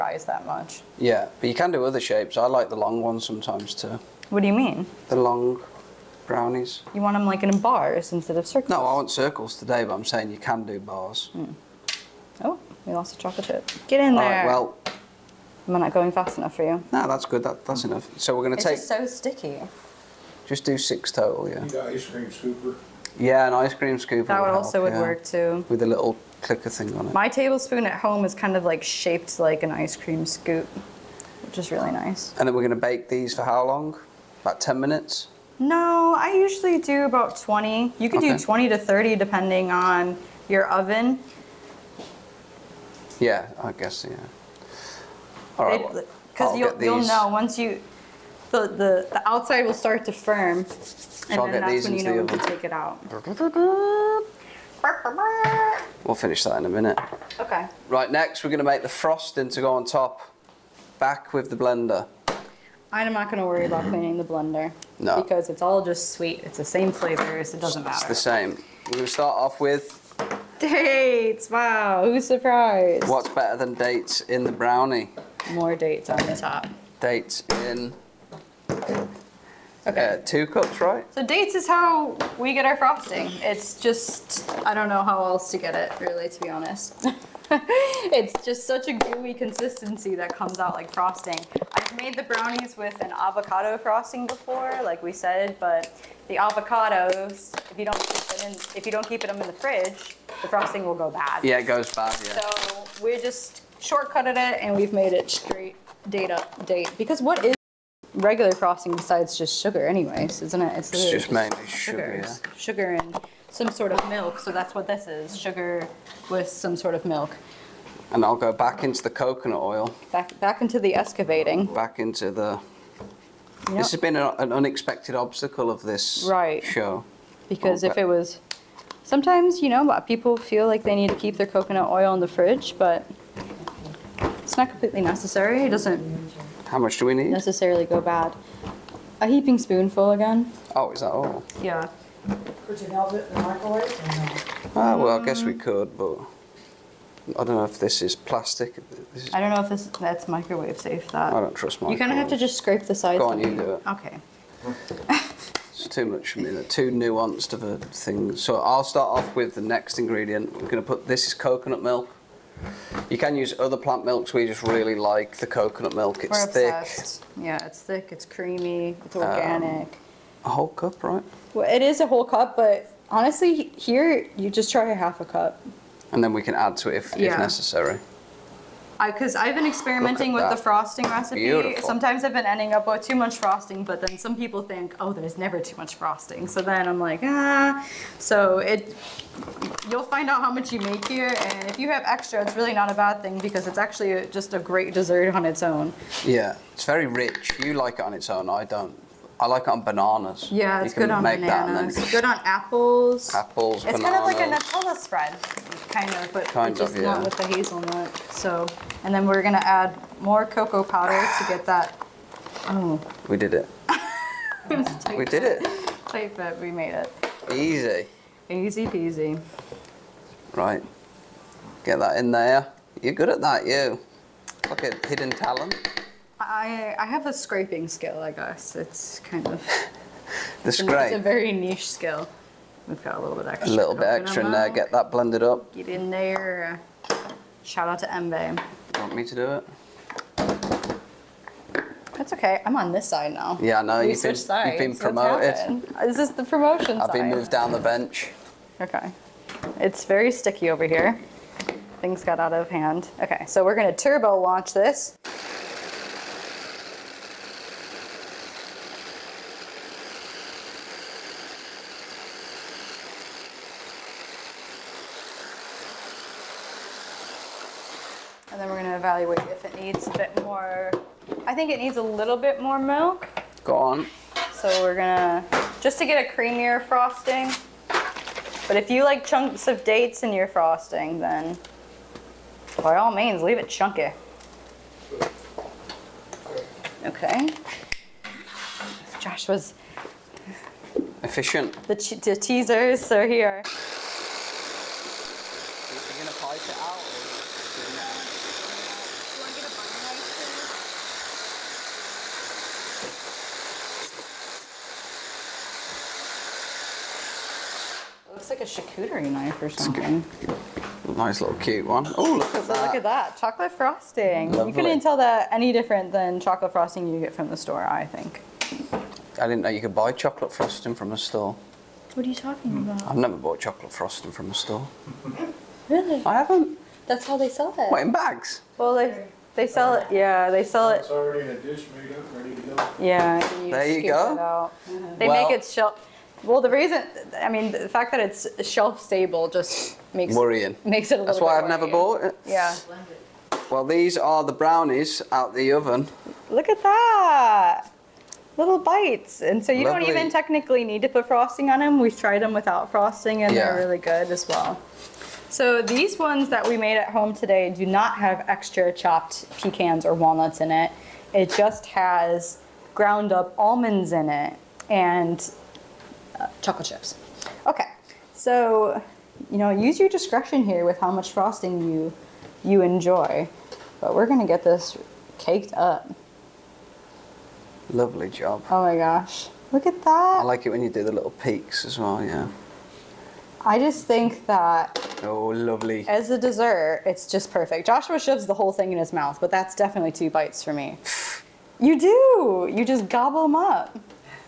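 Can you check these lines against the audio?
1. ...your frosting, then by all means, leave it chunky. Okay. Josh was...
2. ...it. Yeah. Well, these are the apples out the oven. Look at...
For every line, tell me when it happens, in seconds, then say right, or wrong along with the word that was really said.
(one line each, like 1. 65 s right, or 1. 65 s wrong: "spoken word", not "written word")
1. 280 s right
2. 342 s wrong: "brownies", not "apples".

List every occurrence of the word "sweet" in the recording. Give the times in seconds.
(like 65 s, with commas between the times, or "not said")
66 s.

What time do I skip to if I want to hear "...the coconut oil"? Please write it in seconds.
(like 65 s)
119 s.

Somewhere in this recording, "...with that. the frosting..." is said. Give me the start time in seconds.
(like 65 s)
180 s.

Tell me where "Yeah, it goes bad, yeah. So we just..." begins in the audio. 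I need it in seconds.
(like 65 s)
101 s.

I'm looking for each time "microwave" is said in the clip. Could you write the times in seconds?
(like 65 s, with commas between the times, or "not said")
143 s, 150 s.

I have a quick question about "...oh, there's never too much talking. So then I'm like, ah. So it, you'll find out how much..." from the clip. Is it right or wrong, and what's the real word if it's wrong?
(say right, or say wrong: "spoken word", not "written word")
wrong: "frosting", not "talking".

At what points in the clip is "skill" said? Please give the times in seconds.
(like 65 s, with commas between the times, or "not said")
227 s, 231 s.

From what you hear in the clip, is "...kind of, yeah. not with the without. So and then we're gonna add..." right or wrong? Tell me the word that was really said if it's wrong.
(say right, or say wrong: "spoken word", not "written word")
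wrong: "hazelnut", not "without".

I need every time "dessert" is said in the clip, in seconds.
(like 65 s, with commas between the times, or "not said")
194 s, 386 s.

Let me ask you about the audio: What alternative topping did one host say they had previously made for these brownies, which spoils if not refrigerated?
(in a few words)
Avocado frosting.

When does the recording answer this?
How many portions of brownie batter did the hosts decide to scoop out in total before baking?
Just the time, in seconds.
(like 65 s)
20 s.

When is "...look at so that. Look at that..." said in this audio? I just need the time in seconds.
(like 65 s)
312 s.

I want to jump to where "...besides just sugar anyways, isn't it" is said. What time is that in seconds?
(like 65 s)
108 s.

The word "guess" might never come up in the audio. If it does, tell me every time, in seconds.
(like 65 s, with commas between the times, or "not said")
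43 s, 145 s, 228 s.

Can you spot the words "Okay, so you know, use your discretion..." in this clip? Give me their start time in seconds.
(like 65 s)
367 s.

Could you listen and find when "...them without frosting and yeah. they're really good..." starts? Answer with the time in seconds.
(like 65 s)
352 s.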